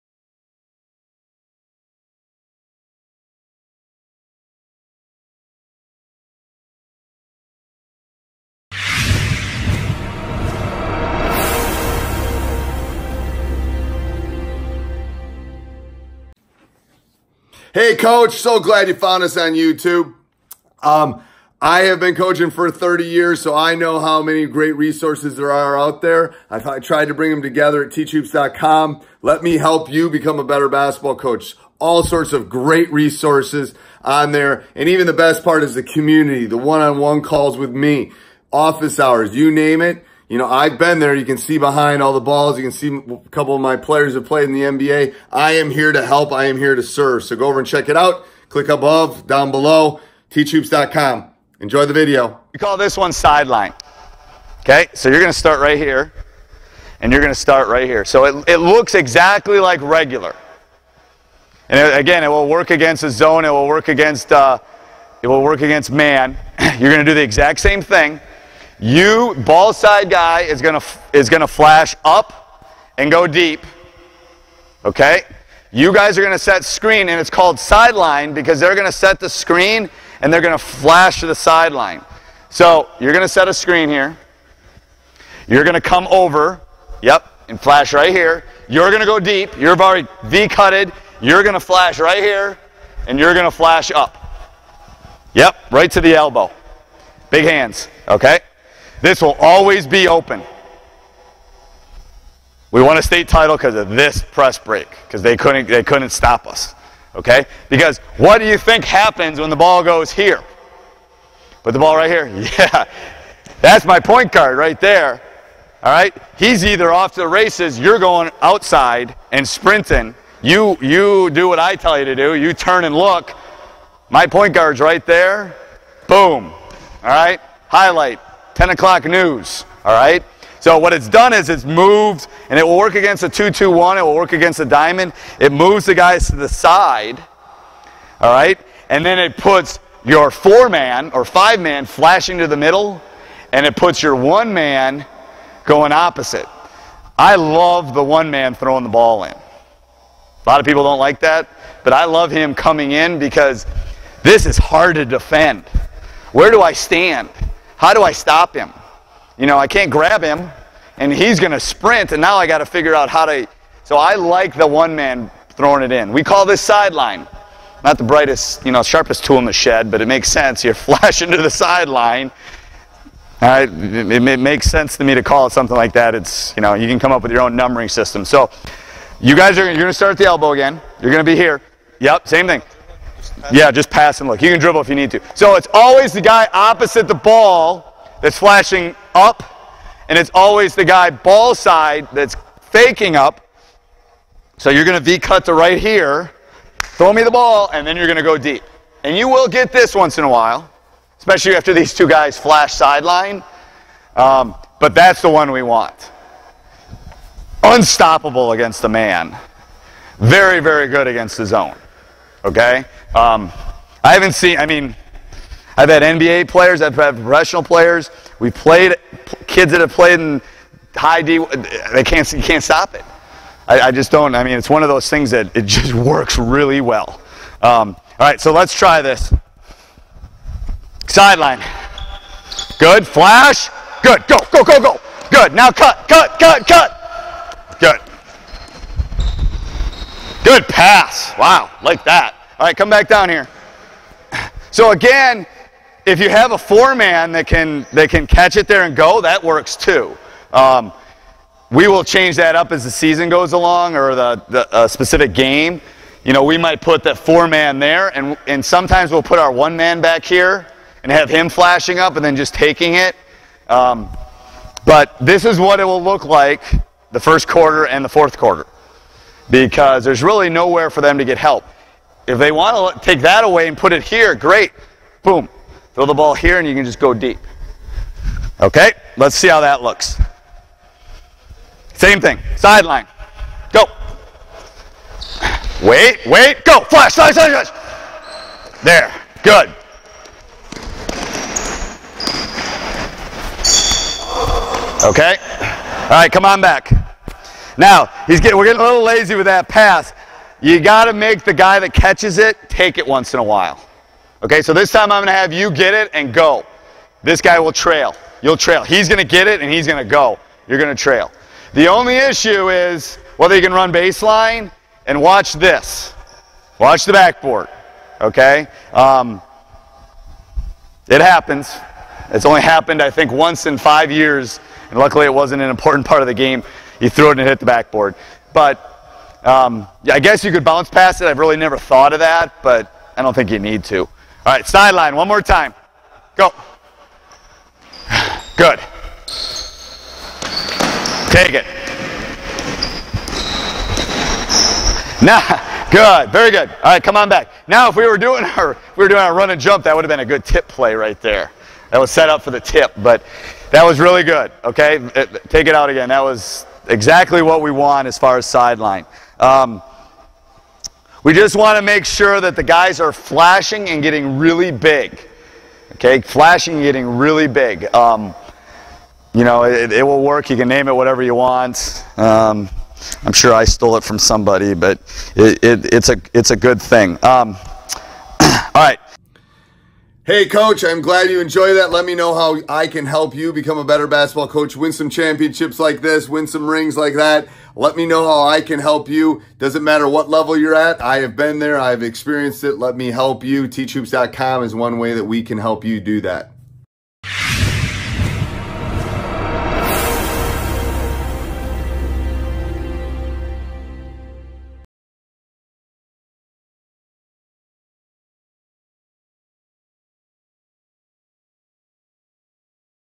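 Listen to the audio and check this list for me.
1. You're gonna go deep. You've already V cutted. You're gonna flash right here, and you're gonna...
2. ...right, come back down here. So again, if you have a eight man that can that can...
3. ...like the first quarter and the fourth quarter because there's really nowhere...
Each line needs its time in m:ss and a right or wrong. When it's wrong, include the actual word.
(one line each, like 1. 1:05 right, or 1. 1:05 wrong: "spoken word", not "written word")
1. 1:28 right
2. 4:02 wrong: "four", not "eight"
3. 4:26 right.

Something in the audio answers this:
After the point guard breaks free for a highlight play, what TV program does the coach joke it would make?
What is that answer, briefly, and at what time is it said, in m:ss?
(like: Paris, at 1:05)
10 o'clock news, at 2:08.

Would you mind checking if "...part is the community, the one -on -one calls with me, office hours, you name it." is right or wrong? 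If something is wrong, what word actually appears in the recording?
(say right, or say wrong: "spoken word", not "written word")
right.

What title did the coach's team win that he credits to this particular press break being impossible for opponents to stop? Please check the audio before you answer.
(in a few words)
state title.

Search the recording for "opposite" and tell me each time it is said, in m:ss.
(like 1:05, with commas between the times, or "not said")
2:25, 3:06.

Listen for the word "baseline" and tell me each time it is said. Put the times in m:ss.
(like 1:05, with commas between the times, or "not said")
5:13.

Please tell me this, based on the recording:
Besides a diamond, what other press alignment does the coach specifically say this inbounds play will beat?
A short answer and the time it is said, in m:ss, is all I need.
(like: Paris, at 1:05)
2-2-1, at 2:13.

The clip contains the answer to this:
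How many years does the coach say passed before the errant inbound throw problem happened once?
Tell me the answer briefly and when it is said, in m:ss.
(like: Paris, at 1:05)
5, at 5:23.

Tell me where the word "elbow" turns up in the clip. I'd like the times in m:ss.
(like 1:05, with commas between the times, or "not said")
1:36, 3:00.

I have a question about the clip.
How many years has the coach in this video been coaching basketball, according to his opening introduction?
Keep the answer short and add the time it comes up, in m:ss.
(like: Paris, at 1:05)
30, at 0:22.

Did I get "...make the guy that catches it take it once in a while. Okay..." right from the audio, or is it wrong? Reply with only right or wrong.
right.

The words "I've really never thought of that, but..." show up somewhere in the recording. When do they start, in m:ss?
5:31.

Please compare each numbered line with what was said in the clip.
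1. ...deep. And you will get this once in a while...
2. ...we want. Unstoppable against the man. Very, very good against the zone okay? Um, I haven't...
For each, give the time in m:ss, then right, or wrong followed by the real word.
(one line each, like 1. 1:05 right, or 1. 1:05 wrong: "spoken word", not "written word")
1. 3:18 right
2. 3:25 right.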